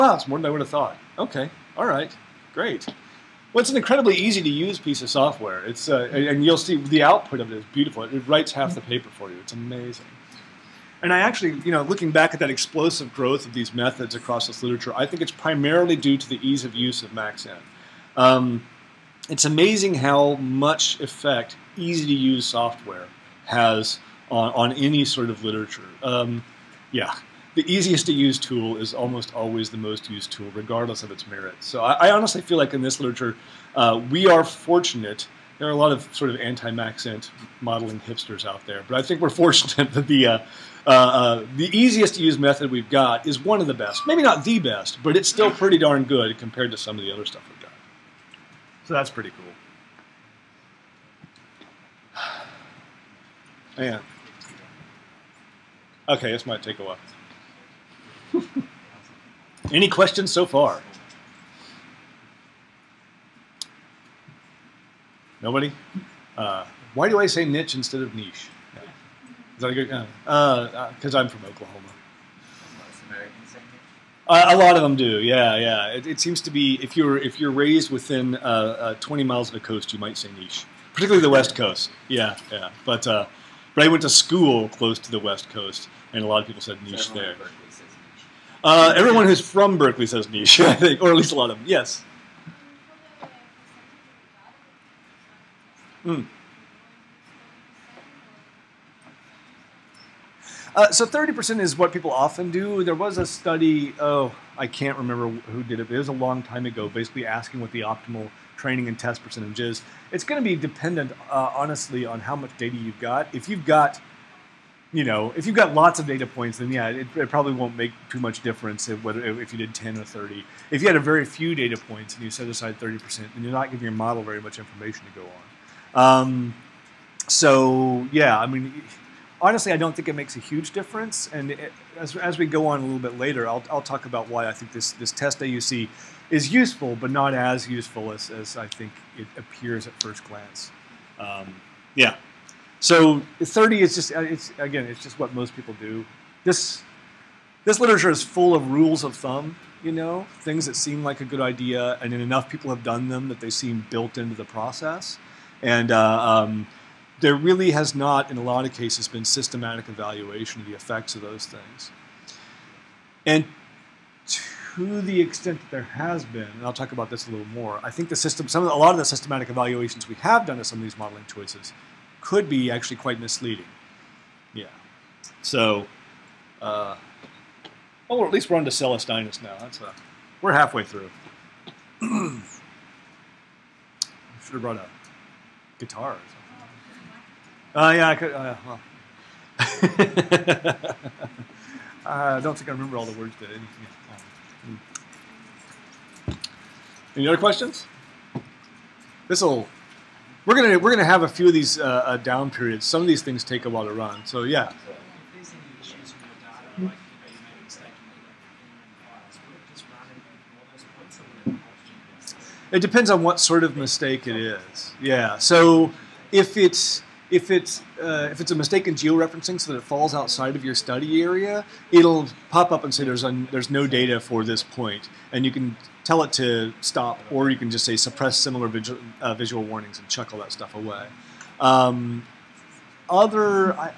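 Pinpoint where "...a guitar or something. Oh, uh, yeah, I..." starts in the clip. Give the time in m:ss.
3:04.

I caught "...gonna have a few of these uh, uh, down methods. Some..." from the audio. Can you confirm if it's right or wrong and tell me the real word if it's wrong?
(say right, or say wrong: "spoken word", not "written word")
wrong: "periods", not "methods".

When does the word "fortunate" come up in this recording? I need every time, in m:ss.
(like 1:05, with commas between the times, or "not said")
0:34, 0:39.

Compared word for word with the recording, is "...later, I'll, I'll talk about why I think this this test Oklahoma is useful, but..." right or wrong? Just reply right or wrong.
wrong.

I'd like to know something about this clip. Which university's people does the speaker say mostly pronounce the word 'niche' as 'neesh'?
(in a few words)
Berkeley.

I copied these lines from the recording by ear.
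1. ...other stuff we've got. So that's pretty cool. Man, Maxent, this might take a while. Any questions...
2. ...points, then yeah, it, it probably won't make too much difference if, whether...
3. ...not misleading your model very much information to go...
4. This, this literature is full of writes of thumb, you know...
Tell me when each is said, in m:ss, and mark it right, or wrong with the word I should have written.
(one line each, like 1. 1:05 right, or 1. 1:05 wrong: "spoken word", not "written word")
1. 0:47 wrong: "Okay", not "Maxent"
2. 1:56 right
3. 2:03 wrong: "giving", not "misleading"
4. 2:26 wrong: "rules", not "writes".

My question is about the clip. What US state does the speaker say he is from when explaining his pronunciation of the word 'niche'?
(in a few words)
Oklahoma.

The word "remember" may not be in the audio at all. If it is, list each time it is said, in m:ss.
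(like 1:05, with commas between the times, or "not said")
1:44, 3:12.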